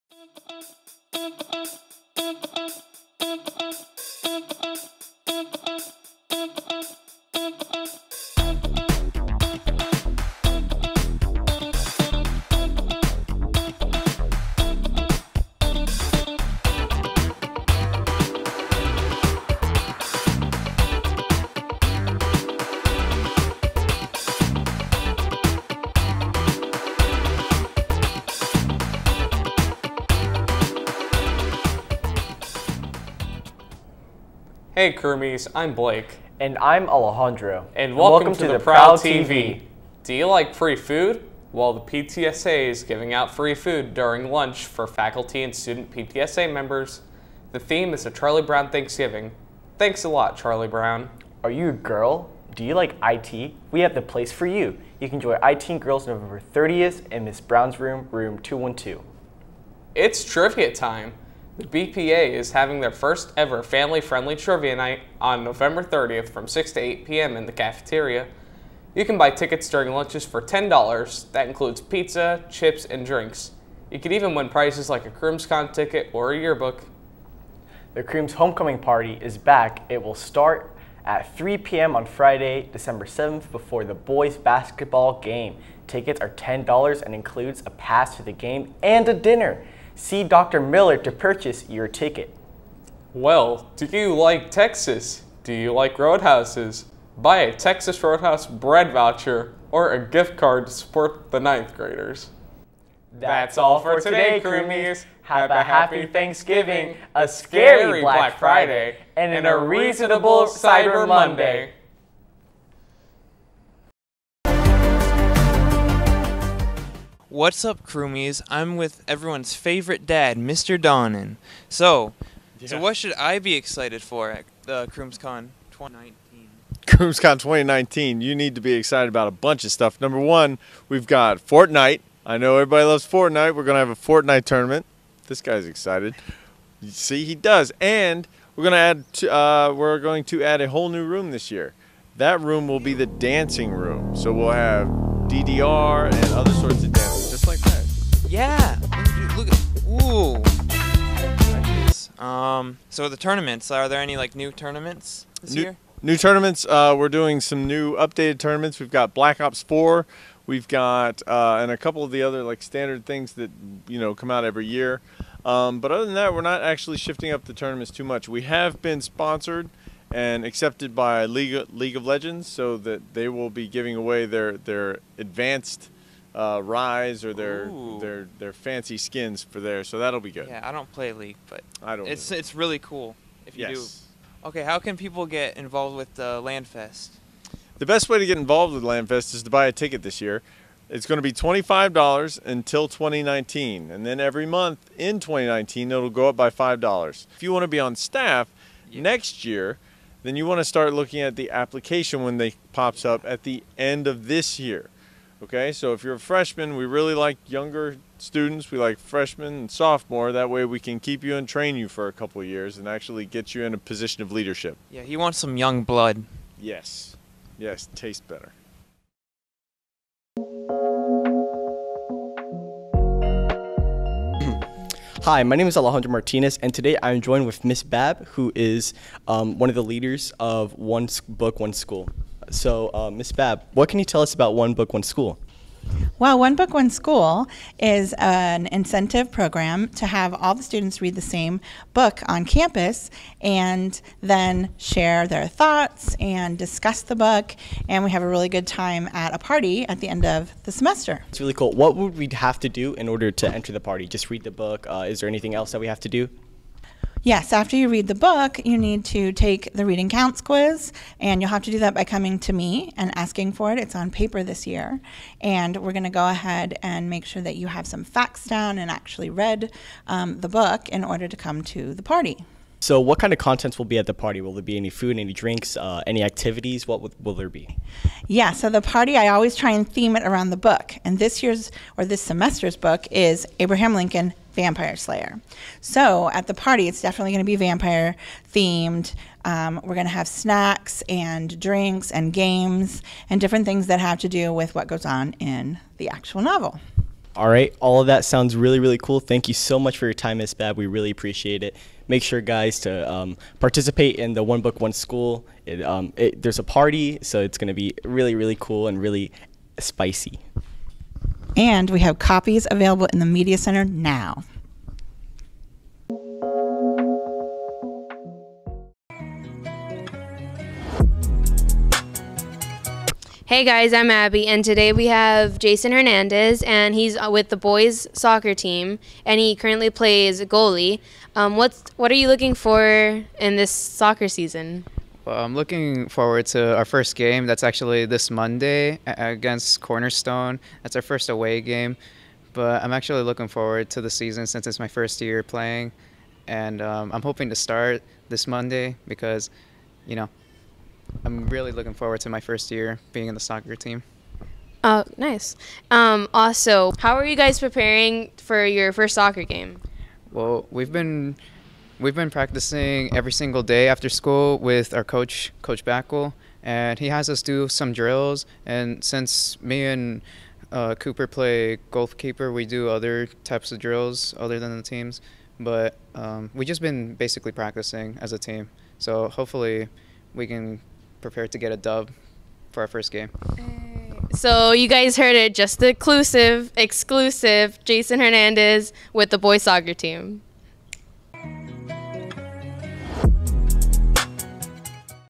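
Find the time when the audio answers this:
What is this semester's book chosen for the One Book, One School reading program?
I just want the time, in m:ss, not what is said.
4:43.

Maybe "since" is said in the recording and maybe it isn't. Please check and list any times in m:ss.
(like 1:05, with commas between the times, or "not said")
5:44, 6:09.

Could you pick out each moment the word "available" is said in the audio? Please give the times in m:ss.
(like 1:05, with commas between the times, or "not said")
5:12.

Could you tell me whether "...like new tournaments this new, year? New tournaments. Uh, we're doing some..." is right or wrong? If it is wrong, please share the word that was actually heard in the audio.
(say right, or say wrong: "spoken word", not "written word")
right.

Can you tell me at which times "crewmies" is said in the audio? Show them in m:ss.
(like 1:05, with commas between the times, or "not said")
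1:44, 1:57.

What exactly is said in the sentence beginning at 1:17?
The Crooms homecoming party is back.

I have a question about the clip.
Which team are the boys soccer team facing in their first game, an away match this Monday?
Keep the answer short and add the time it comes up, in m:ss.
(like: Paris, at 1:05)
Cornerstone, at 5:39.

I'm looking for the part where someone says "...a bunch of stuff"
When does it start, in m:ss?
2:09.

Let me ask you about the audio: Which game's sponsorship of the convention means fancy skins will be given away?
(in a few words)
League of Legends.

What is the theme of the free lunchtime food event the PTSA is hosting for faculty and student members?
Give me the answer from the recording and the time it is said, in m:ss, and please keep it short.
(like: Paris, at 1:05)
A Charlie Brown Thanksgiving, at 0:48.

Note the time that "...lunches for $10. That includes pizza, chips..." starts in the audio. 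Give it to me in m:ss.
1:09.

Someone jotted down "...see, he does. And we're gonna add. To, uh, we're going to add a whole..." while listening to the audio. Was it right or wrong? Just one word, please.
right.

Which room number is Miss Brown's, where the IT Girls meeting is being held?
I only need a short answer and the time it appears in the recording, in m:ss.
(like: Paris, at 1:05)
212, at 0:58.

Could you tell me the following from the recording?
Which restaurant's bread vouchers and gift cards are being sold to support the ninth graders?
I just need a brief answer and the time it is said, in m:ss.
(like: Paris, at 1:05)
Texas Roadhouse, at 1:37.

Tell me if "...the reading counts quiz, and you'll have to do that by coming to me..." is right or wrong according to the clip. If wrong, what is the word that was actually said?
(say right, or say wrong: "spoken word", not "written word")
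right.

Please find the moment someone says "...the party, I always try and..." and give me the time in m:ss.
4:38.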